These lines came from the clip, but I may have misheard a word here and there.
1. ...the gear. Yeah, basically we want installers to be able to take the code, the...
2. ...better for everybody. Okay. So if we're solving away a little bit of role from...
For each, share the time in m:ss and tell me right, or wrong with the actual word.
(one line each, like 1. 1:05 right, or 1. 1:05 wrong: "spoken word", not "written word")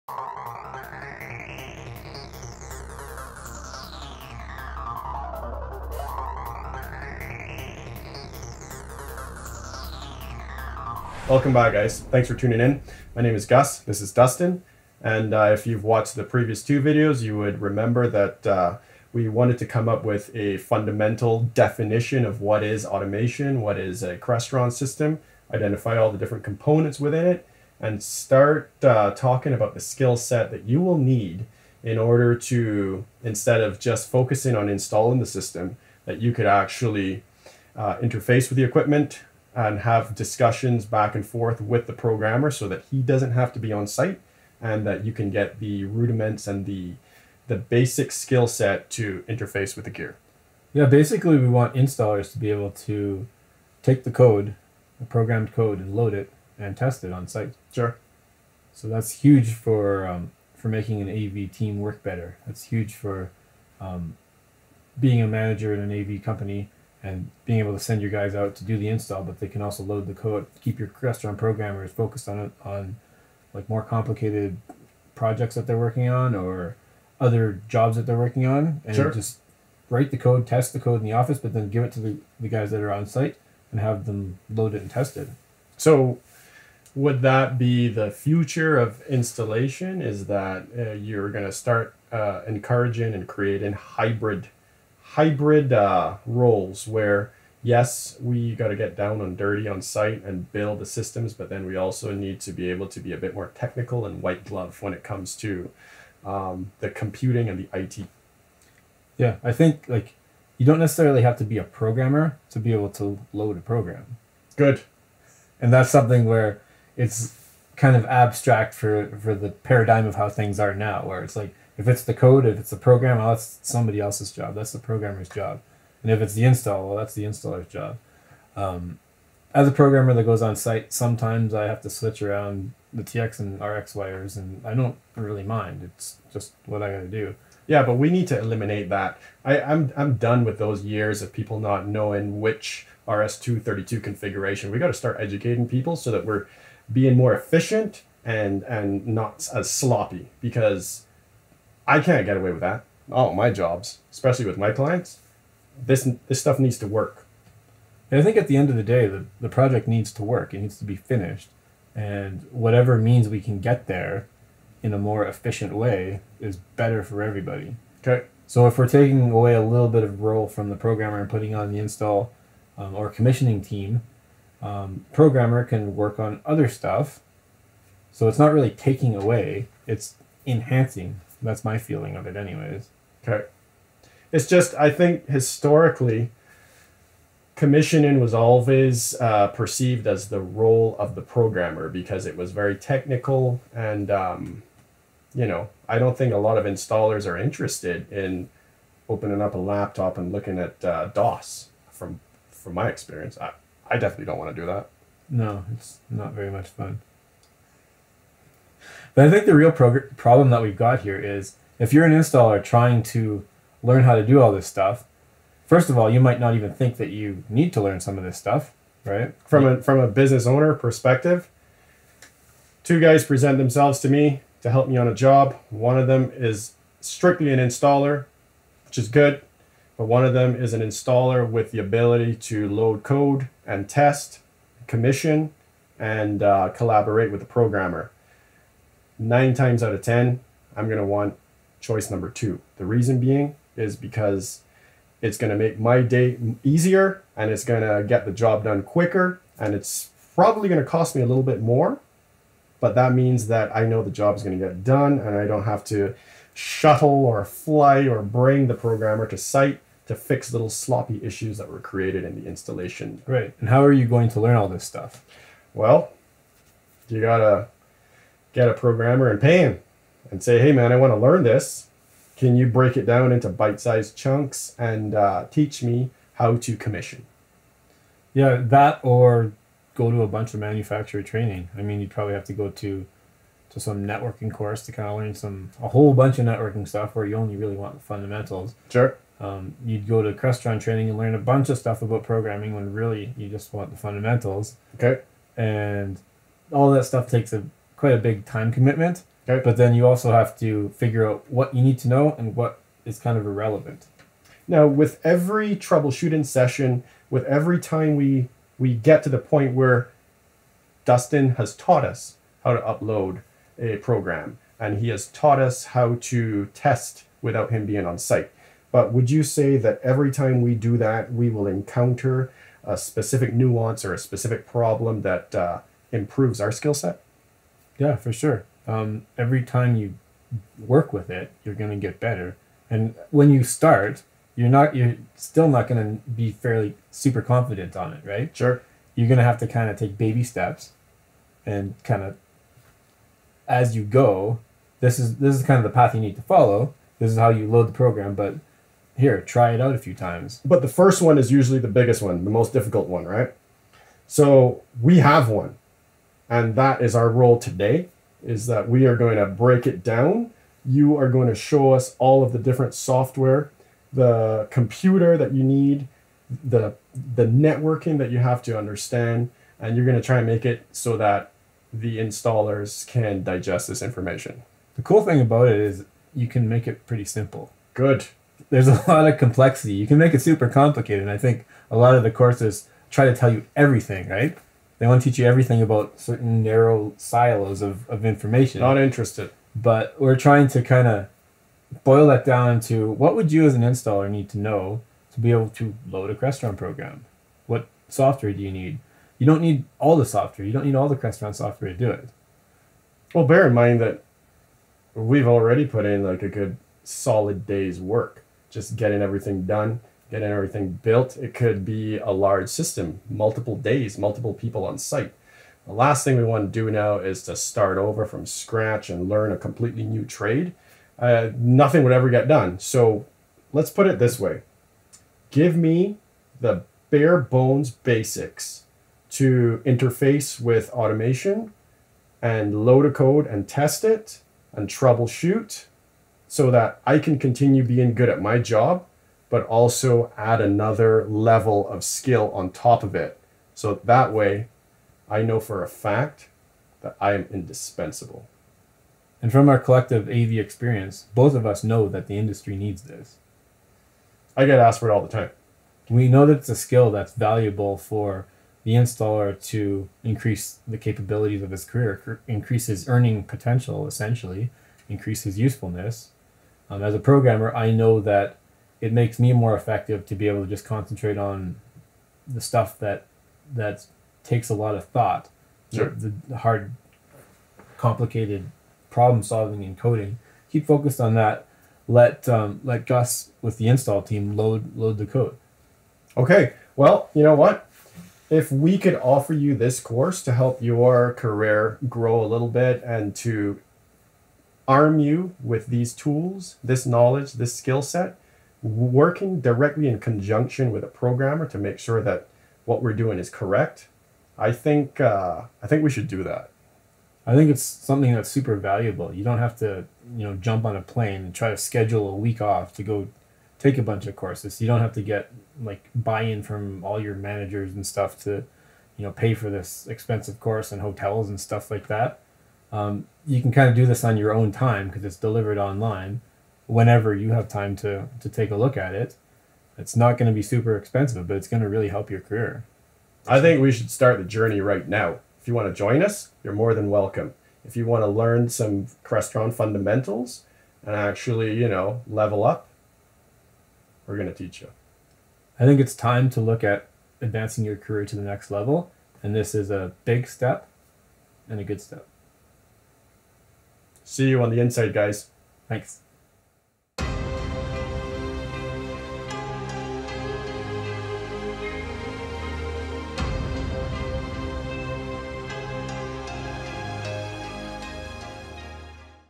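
1. 0:49 right
2. 2:46 wrong: "taking", not "solving".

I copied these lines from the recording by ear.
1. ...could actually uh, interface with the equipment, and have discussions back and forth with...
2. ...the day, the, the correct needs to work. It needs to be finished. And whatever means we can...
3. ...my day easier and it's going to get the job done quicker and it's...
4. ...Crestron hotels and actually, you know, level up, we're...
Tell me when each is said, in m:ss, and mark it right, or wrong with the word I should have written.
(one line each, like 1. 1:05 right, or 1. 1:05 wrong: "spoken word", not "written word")
1. 0:36 right
2. 2:38 wrong: "project", not "correct"
3. 4:05 right
4. 8:59 wrong: "fundamentals", not "hotels".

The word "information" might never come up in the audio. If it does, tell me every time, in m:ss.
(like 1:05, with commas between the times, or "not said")
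6:14, 6:28.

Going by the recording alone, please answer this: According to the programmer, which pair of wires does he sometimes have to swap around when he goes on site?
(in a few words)
TX and RX.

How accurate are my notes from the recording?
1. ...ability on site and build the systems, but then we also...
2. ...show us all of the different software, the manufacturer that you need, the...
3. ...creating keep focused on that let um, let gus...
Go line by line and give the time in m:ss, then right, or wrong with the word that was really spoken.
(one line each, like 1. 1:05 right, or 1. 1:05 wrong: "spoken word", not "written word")
1. 1:39 wrong: "dirty", not "ability"
2. 6:01 wrong: "computer", not "manufacturer"
3. 7:59 wrong: "coding", not "creating".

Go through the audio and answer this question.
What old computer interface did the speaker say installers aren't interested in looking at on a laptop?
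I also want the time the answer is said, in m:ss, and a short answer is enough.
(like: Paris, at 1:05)
DOS, at 3:21.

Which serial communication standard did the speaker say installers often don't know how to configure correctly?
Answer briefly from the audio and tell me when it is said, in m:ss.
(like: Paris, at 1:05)
RS-232, at 2:23.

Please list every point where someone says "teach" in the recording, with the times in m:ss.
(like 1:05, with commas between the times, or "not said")
4:35, 6:25, 9:04.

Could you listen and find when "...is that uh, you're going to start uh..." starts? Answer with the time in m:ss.
1:30.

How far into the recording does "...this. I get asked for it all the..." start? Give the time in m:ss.
7:33.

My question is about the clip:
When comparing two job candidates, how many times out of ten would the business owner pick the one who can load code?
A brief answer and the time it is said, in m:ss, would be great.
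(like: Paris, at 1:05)
9, at 3:59.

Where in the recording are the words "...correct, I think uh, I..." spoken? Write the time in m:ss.
8:23.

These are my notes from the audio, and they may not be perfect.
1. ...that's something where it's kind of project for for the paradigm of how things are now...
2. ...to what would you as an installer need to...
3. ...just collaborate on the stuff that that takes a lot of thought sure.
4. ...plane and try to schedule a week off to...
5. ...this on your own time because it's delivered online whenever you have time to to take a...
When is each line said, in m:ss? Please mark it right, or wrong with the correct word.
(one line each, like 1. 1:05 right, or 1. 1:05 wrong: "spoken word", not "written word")
1. 1:55 wrong: "abstract", not "project"
2. 6:32 right
3. 7:50 wrong: "concentrate", not "collaborate"
4. 8:31 right
5. 8:44 right.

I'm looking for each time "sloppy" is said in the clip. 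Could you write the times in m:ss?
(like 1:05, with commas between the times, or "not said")
2:29, 4:20.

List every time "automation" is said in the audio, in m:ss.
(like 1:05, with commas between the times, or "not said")
0:22, 7:10.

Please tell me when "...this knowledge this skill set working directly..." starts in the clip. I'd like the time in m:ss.
8:16.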